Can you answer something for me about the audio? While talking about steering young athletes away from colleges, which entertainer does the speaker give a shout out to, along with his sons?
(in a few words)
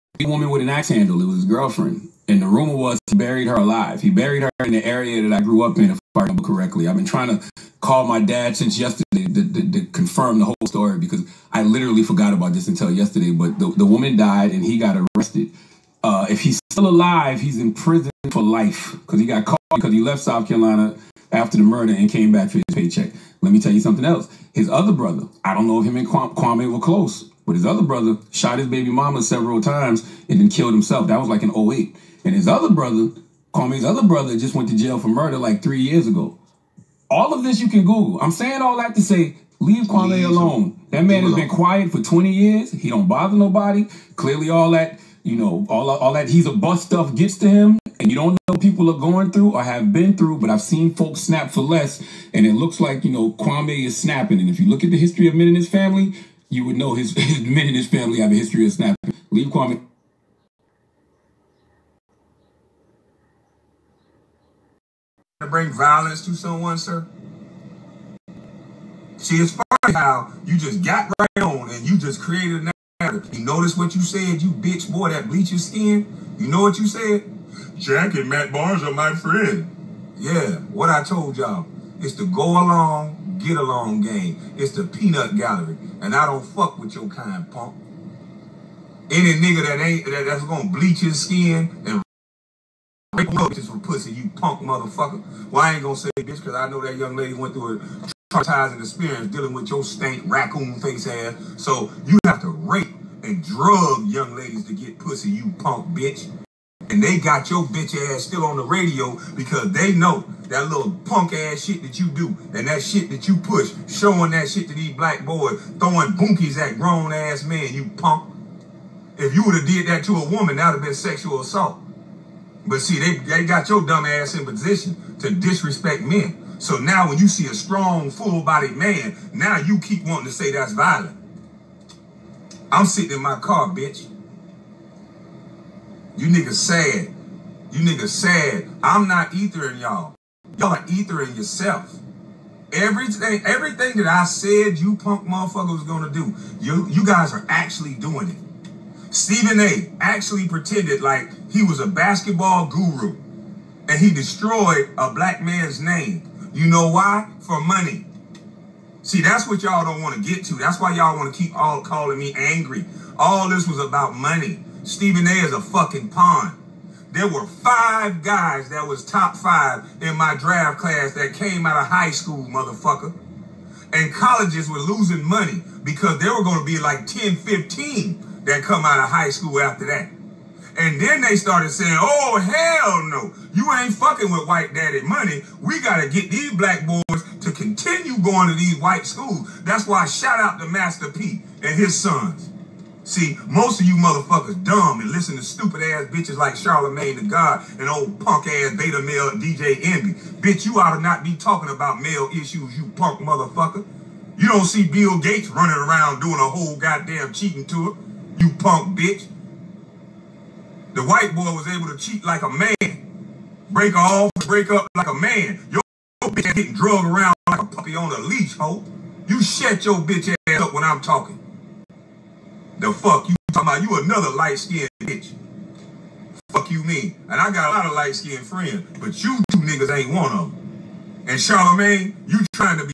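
Master P.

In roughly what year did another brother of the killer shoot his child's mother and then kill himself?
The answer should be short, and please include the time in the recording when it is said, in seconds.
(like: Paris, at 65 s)
2008, at 31 s.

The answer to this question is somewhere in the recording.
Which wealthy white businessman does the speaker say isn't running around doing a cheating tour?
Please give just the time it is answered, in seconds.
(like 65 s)
204 s.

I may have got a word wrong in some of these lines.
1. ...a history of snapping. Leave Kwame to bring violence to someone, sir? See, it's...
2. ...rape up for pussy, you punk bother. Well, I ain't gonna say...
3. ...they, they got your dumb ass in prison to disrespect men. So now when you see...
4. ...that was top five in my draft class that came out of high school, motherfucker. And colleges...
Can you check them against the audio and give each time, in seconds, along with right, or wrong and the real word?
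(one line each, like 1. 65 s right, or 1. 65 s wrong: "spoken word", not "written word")
1. 58 s right
2. 93 s wrong: "motherfucker", not "bother"
3. 122 s wrong: "position", not "prison"
4. 168 s right.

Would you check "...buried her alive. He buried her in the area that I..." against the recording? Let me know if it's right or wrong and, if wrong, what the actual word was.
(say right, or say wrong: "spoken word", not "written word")
right.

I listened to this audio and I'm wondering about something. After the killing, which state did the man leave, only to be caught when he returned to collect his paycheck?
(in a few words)
South Carolina.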